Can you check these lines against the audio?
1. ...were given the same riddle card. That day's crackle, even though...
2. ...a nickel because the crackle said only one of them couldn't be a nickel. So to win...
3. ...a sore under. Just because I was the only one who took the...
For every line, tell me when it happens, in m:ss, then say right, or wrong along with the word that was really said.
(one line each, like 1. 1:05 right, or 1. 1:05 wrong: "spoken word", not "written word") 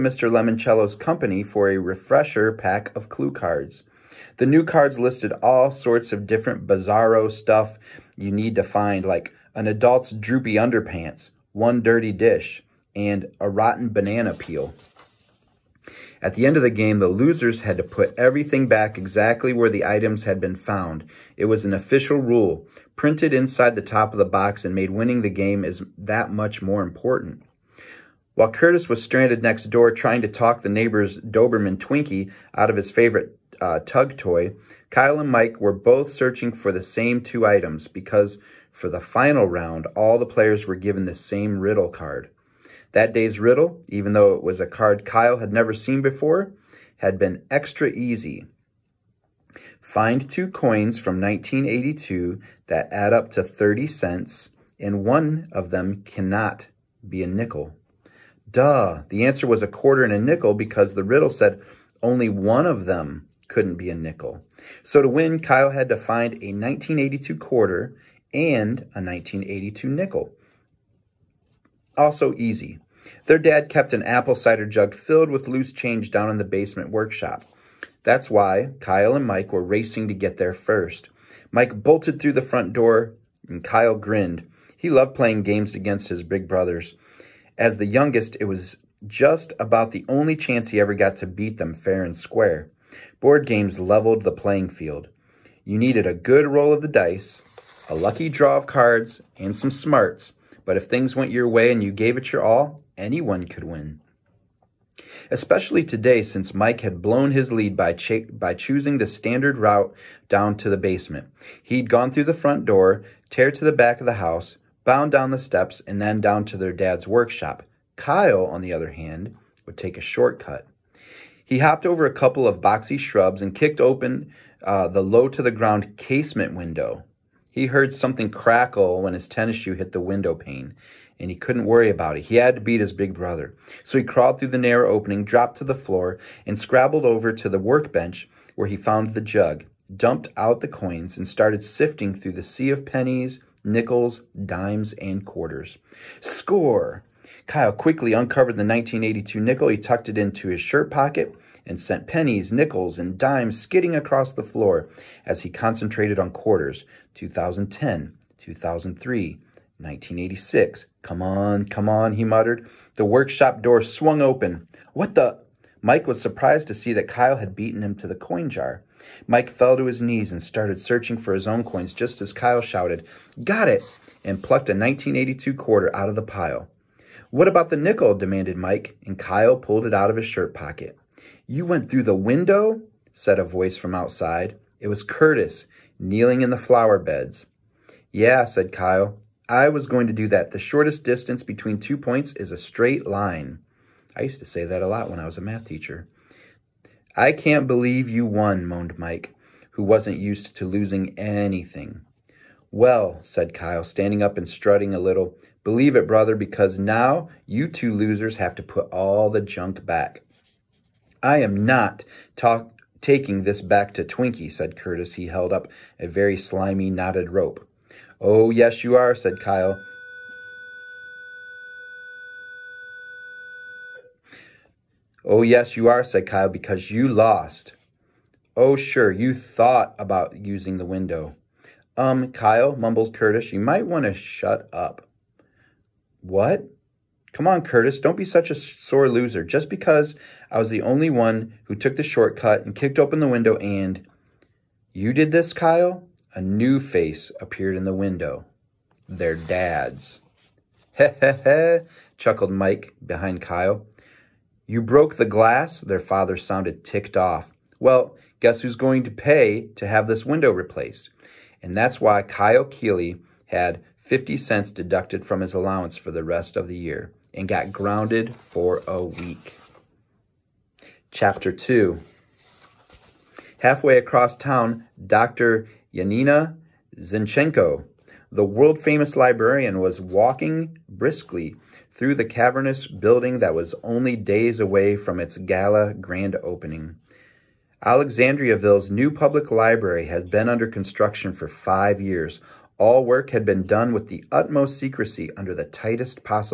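1. 0:40 wrong: "riddle", not "crackle"
2. 1:00 wrong: "riddle", not "crackle"
3. 3:58 wrong: "loser", not "under".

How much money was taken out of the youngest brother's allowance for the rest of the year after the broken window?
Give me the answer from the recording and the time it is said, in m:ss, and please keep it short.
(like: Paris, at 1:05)
50 cents, at 4:23.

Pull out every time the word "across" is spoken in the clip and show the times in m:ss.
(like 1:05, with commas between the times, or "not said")
2:33, 4:33.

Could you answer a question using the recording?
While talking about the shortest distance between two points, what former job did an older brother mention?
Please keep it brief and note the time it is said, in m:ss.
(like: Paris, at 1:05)
math teacher, at 3:15.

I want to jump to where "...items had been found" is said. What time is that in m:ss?
0:19.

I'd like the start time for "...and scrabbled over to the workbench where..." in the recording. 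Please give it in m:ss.
2:16.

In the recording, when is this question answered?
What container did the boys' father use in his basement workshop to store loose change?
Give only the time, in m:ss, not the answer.
1:14.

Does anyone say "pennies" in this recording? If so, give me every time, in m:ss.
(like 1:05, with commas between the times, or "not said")
2:22, 2:32.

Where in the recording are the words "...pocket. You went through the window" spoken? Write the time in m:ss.
3:00.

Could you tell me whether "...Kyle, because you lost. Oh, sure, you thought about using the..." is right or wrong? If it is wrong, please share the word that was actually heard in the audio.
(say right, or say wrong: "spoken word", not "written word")
right.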